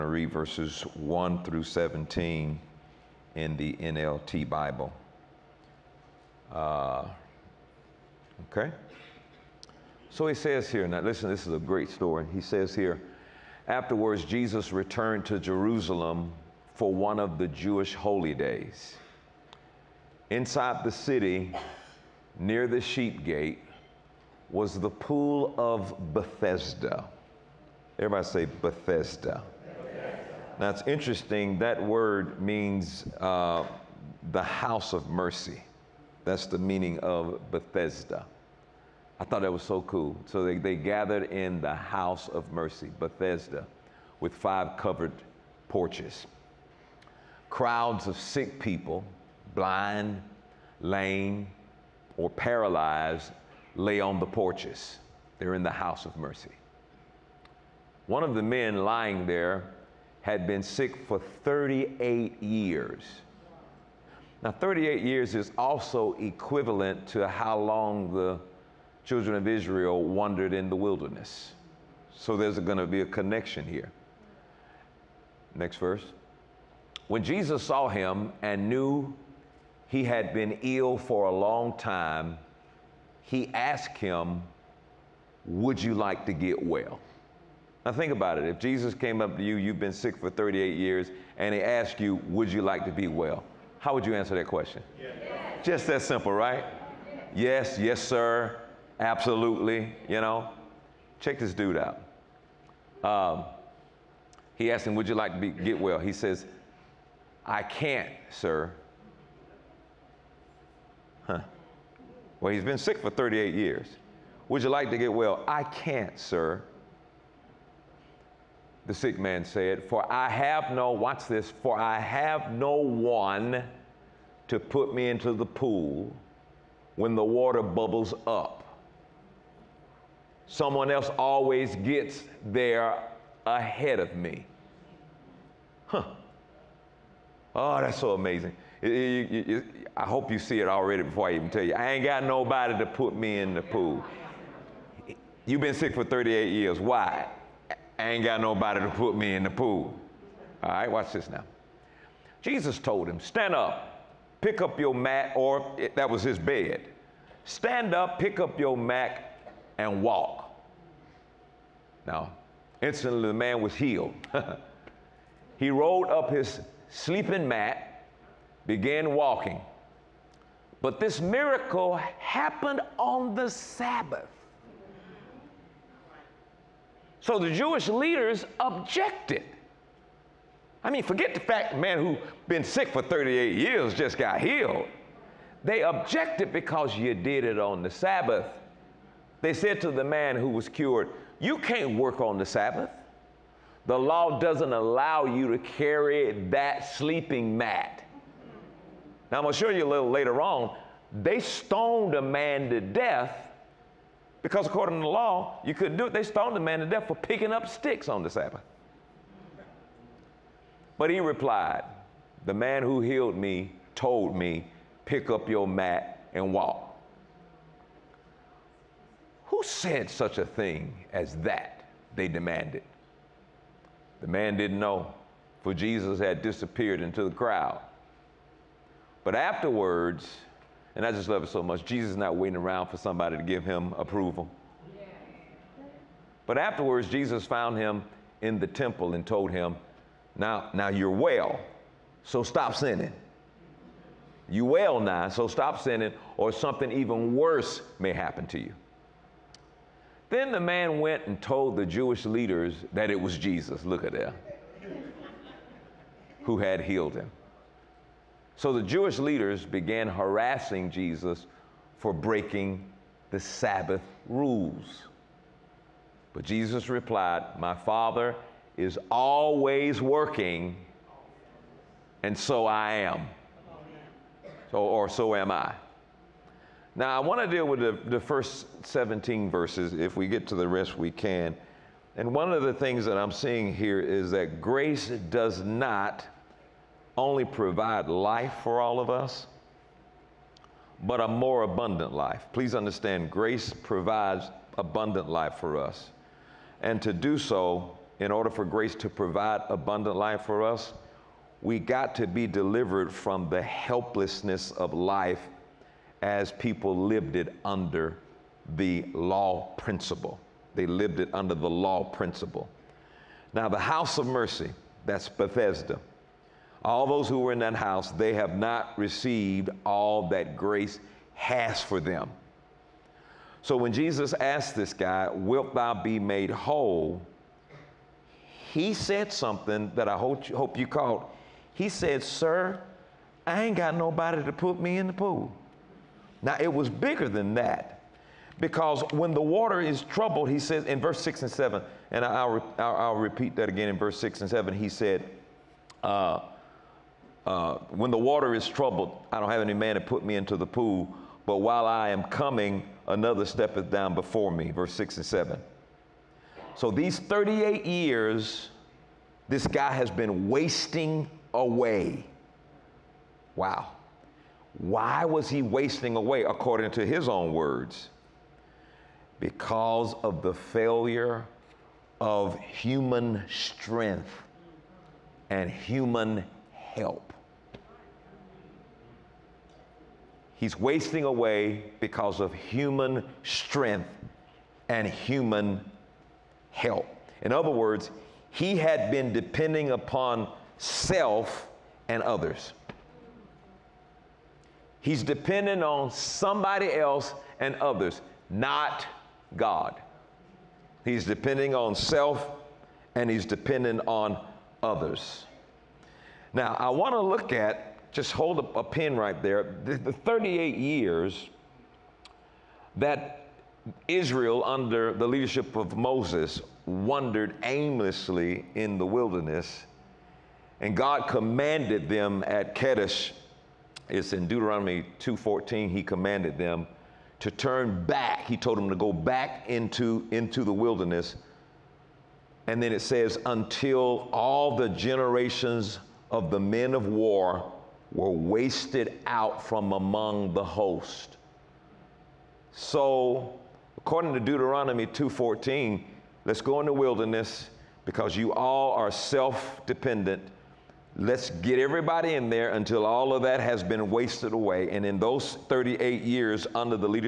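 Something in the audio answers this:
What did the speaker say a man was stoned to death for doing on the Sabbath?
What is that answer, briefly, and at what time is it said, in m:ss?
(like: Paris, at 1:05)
picking up sticks, at 3:27.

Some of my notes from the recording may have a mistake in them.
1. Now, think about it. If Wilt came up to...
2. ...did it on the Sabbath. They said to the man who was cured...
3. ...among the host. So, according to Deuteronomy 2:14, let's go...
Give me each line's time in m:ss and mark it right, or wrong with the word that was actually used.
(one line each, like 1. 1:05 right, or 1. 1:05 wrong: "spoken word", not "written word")
1. 1:27 wrong: "Jesus", not "Wilt"
2. 3:07 right
3. 7:19 right.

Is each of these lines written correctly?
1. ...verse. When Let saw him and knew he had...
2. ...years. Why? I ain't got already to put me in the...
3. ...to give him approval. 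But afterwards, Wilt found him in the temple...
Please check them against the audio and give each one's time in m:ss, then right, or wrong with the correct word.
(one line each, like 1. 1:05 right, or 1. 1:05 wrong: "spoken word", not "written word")
1. 1:15 wrong: "Jesus", not "Let"
2. 2:26 wrong: "nobody", not "already"
3. 3:53 wrong: "Jesus", not "Wilt".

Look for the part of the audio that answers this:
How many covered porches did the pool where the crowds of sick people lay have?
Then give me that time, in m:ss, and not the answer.
0:44.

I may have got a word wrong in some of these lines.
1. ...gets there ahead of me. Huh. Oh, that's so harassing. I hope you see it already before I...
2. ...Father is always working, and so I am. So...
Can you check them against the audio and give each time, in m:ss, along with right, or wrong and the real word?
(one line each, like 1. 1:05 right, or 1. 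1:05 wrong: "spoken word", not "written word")
1. 2:11 wrong: "amazing", not "harassing"
2. 4:27 right.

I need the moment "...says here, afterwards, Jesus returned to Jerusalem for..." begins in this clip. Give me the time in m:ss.
0:12.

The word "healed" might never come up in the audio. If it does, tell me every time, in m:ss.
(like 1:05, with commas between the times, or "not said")
2:43, 3:04, 3:33, 4:16.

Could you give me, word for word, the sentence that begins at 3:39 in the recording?
Who said such a thing as that?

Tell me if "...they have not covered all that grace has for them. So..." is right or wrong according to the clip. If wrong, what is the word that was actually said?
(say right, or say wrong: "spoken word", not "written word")
wrong: "received", not "covered".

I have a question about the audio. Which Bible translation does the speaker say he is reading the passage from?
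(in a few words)
NLT.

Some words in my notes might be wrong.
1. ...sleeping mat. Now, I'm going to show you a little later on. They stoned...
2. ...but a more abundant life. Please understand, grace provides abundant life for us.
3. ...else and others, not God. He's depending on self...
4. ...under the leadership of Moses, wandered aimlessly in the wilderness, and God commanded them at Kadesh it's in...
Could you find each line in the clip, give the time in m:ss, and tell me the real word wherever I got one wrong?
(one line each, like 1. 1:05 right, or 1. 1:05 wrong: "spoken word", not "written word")
1. 3:16 right
2. 4:51 right
3. 6:36 right
4. 6:54 right.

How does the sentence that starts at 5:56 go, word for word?
So these 38 years, this guy has been wasting away.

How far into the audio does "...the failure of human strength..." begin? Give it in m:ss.
6:10.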